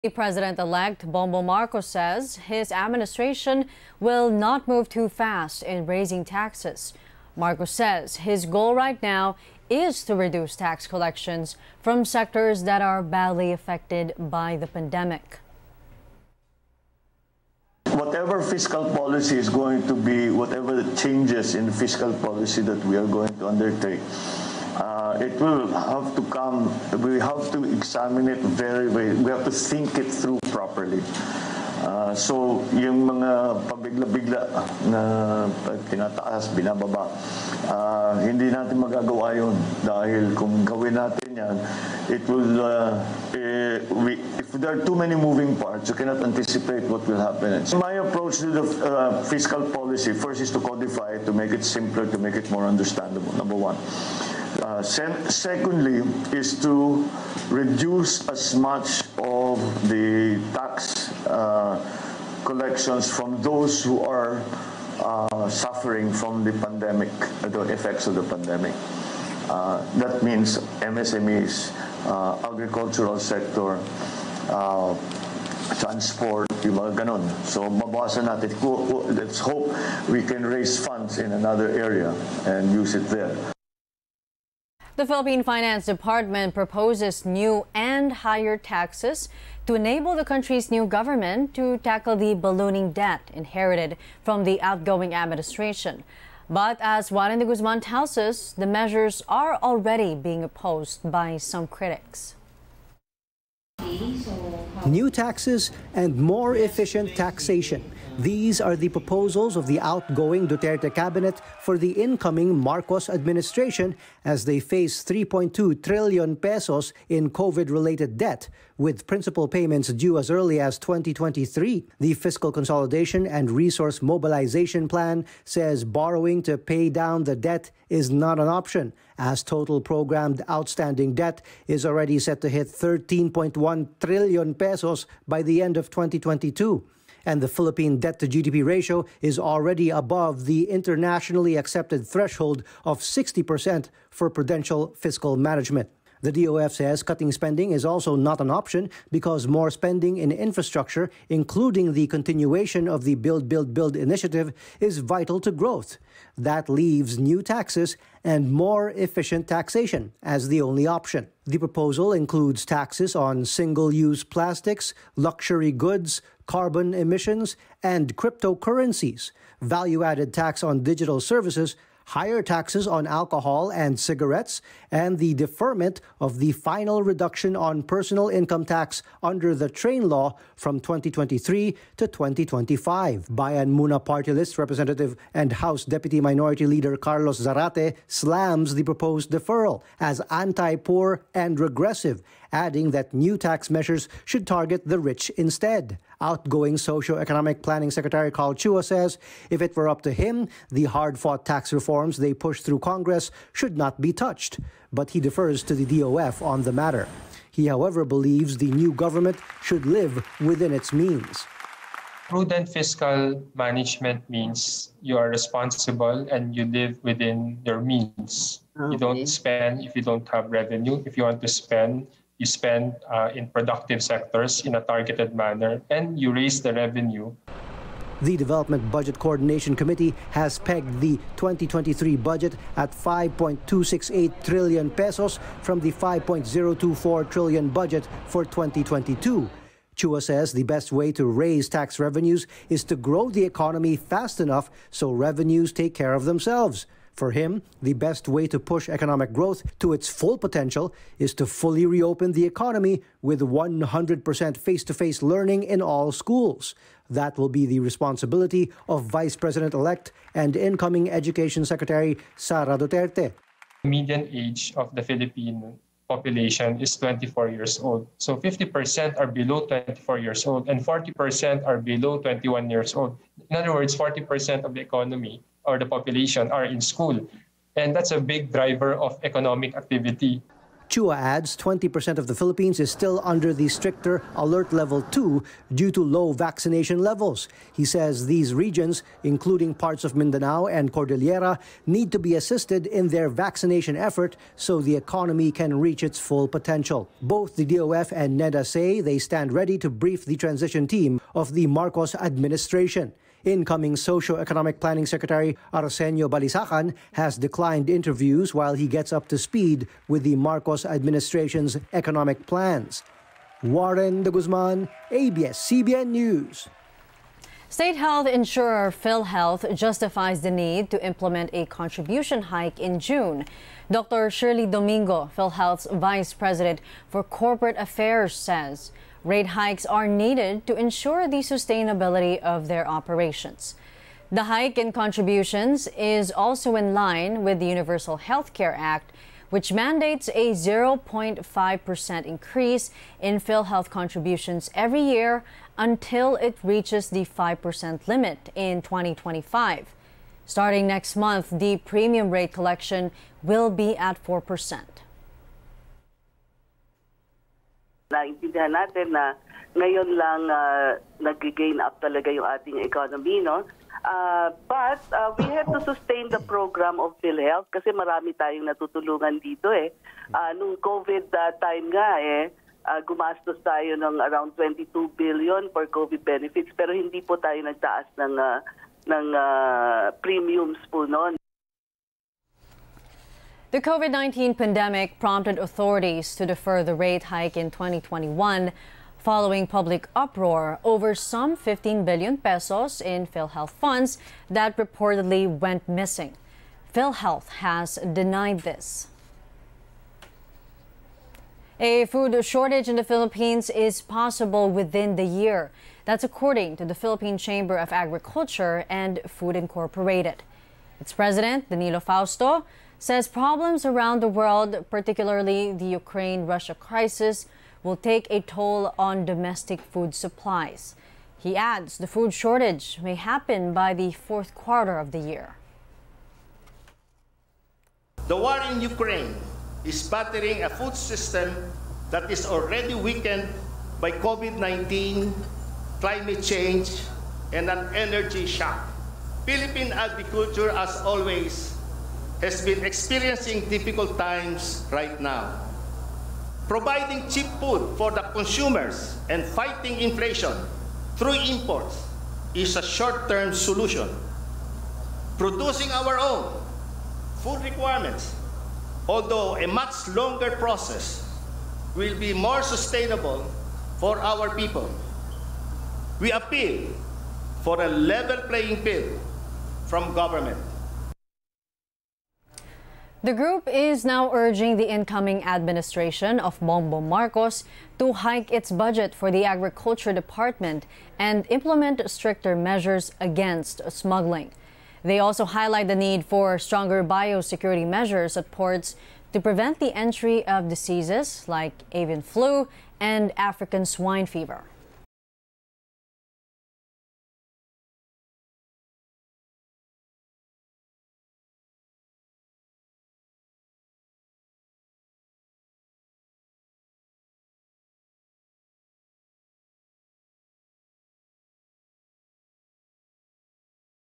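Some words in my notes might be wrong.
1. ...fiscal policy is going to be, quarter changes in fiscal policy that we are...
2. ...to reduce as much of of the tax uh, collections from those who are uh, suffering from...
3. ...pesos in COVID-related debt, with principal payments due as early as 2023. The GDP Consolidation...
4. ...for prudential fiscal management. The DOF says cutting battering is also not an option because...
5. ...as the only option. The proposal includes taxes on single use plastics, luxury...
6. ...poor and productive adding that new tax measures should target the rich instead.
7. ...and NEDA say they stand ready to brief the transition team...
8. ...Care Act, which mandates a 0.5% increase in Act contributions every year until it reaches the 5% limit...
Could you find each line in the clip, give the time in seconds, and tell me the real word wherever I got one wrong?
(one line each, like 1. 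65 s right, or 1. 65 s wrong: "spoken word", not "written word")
1. 18 s wrong: "whatever", not "quarter"
2. 56 s right
3. 116 s wrong: "Fiscal", not "GDP"
4. 144 s wrong: "spending", not "battering"
5. 160 s right
6. 190 s wrong: "regressive", not "productive"
7. 298 s right
8. 338 s wrong: "PhilHealth", not "Act".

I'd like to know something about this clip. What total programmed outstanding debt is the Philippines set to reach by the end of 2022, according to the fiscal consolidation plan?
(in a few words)
13.1 trillion pesos.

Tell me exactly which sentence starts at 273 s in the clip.
In other words, 40% of the economy or the population are in school.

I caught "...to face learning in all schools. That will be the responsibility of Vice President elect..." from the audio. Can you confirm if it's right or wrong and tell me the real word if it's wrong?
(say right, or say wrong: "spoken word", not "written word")
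right.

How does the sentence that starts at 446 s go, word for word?
Providing cheap food for the consumers and fighting inflation through imports is a short-term solution.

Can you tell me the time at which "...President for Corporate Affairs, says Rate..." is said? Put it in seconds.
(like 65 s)
326 s.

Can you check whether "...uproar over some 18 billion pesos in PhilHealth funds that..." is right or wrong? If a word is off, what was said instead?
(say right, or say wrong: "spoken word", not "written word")
wrong: "15", not "18".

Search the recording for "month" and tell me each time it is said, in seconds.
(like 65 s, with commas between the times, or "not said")
351 s.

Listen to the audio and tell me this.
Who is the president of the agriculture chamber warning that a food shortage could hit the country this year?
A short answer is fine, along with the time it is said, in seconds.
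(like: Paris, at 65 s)
Danilo Fausto, at 411 s.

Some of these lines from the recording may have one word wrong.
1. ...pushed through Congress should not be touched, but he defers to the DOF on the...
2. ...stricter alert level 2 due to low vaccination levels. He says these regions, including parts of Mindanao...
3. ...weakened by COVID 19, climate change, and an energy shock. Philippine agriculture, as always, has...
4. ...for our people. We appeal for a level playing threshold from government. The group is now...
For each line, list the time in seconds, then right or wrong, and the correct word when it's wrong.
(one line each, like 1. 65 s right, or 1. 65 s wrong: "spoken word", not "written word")
1. 202 s right
2. 283 s right
3. 432 s right
4. 463 s wrong: "field", not "threshold".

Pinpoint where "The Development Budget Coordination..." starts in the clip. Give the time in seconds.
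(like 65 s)
228 s.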